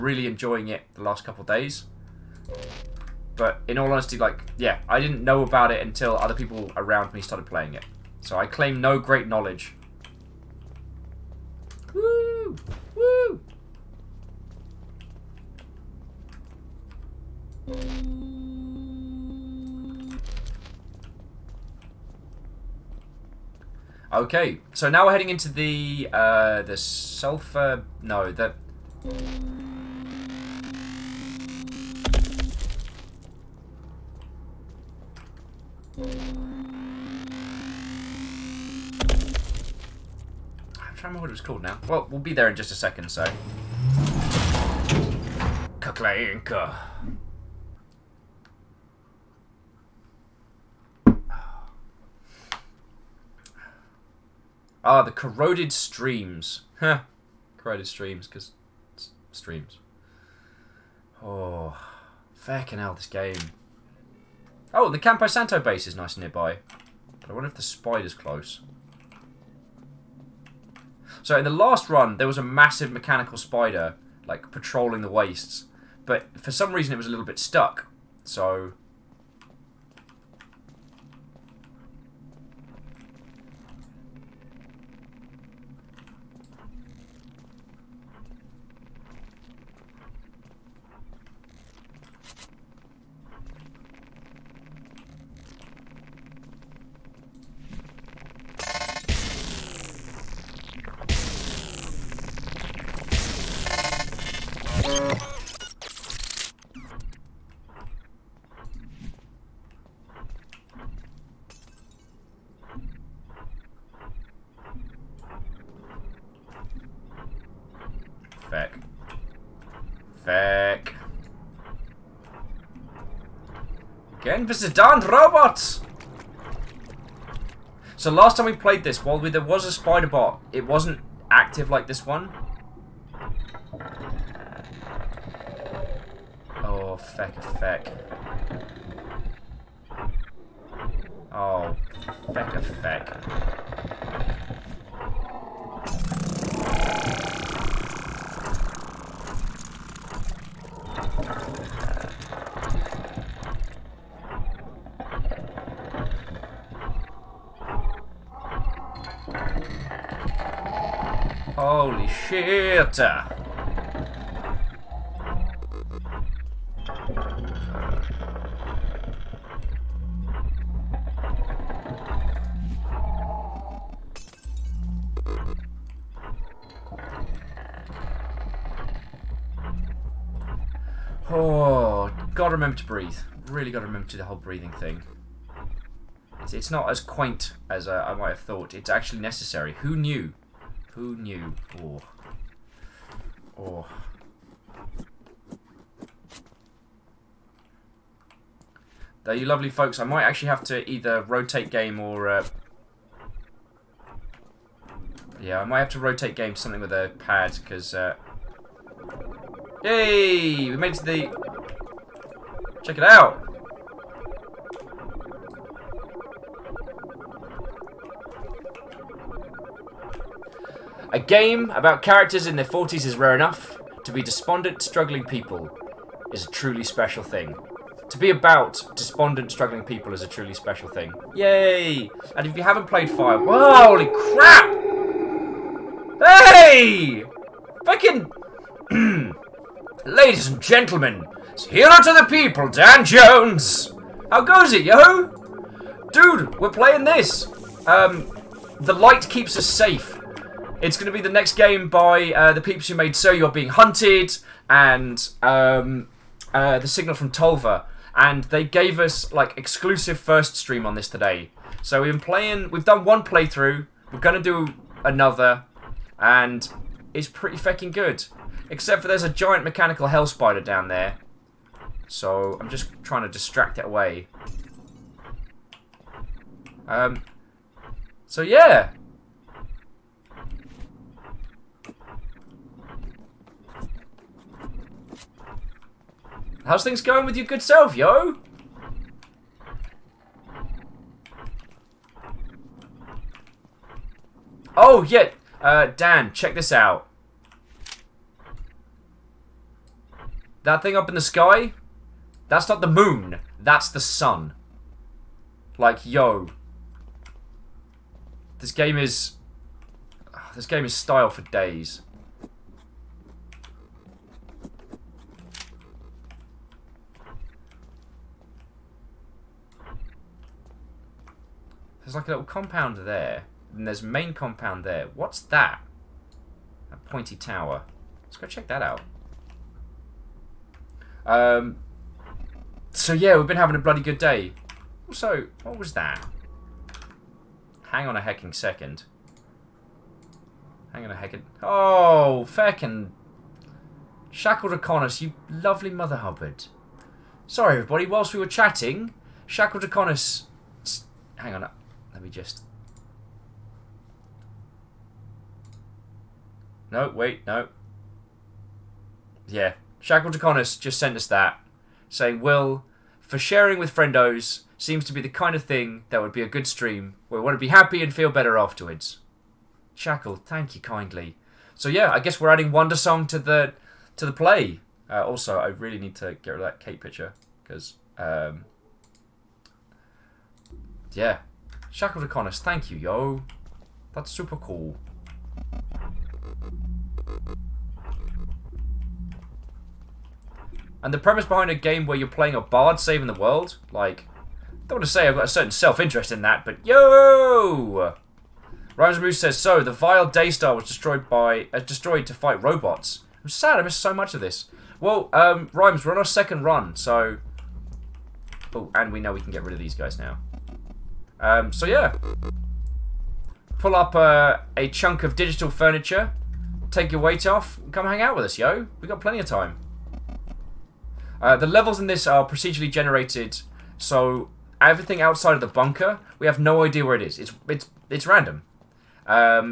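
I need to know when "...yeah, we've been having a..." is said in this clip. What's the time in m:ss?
5:33.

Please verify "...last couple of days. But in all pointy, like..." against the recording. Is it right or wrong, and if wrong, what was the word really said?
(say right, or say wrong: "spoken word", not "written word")
wrong: "honesty", not "pointy".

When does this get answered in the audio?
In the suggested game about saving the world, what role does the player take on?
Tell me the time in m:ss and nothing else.
6:32.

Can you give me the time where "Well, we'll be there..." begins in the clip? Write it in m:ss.
0:41.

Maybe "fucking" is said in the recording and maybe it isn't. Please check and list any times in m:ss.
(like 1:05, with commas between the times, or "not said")
3:57, 4:27.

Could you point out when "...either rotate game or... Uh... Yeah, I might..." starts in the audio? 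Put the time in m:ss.
3:20.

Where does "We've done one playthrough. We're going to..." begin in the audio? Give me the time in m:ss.
4:22.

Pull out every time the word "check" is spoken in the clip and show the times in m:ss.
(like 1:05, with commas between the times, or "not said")
3:32, 4:56, 5:28.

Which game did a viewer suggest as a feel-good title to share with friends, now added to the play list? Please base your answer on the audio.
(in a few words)
Wandersong.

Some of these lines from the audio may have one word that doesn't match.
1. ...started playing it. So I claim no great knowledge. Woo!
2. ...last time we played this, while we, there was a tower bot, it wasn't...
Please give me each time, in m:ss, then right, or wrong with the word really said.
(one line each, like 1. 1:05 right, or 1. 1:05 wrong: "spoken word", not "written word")
1. 0:07 right
2. 2:08 wrong: "spider", not "tower".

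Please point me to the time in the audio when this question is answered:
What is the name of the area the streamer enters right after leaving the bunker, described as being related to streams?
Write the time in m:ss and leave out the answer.
0:55.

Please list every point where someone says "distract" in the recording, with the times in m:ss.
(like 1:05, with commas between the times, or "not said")
4:33.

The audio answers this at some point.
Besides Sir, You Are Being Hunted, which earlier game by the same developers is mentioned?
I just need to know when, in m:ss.
4:16.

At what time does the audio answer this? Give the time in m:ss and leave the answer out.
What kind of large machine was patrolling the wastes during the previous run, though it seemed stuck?
1:12.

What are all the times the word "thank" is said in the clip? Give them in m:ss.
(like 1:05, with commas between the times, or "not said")
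6:10, 6:22.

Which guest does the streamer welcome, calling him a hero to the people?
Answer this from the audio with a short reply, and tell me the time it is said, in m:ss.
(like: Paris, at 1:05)
Dan Jones, at 4:02.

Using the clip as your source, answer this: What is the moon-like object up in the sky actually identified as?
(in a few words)
The sun.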